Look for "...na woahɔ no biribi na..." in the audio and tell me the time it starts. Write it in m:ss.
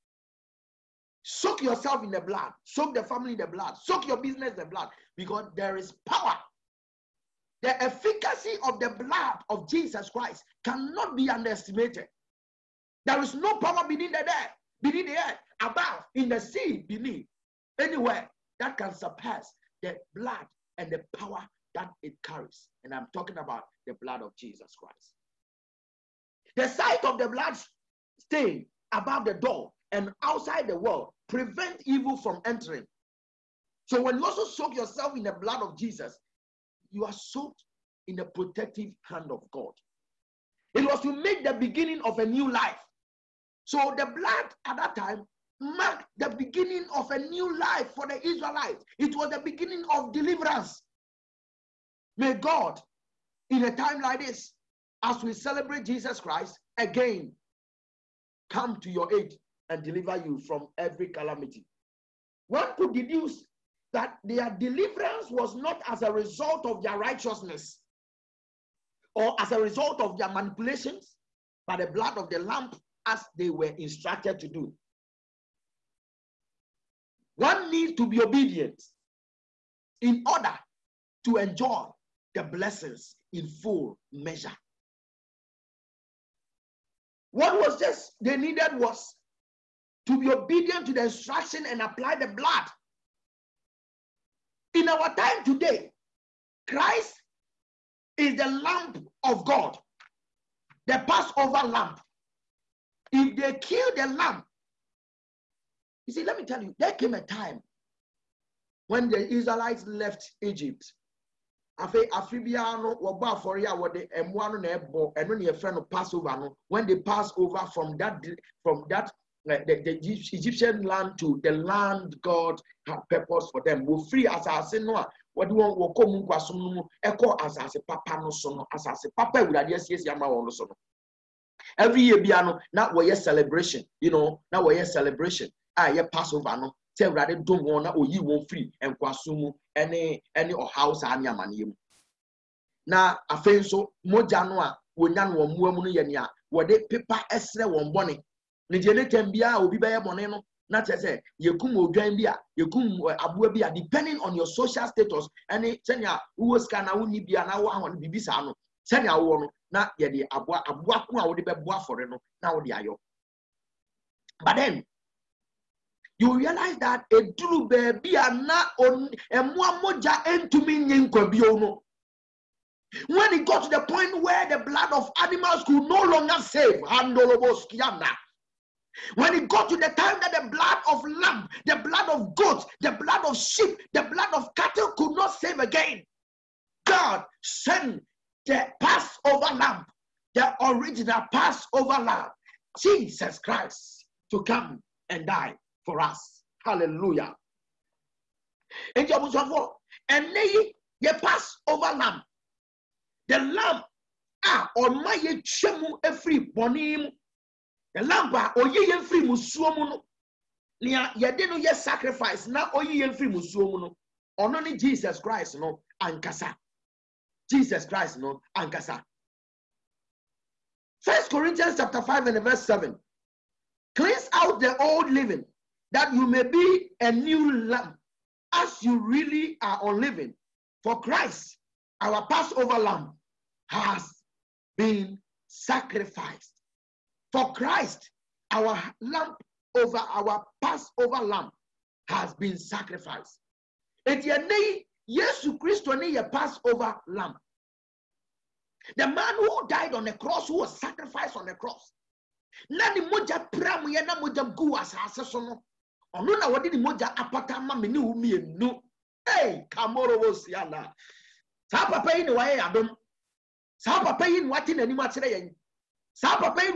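2:37.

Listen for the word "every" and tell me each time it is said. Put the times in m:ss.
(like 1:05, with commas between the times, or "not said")
1:00, 2:11, 3:26.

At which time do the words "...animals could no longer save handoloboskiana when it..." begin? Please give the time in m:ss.
2:55.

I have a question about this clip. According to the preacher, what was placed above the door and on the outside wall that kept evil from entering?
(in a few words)
blood stain.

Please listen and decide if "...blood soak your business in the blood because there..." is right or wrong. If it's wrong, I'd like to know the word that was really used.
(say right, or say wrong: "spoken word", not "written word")
right.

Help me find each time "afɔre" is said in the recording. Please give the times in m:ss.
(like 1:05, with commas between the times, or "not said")
1:53, 2:41.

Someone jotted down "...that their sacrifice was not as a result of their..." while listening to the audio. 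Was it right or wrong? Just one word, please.
wrong.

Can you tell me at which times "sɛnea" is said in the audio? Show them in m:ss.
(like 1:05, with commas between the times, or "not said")
2:35.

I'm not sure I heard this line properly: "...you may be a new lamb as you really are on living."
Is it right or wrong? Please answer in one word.
right.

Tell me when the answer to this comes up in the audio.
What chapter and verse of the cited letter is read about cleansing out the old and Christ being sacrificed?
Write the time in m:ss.
3:41.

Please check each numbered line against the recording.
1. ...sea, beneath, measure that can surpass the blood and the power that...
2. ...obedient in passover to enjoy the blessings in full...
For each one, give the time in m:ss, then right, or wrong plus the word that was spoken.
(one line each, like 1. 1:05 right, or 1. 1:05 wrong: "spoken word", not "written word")
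1. 0:16 wrong: "anywhere", not "measure"
2. 1:18 wrong: "order", not "passover".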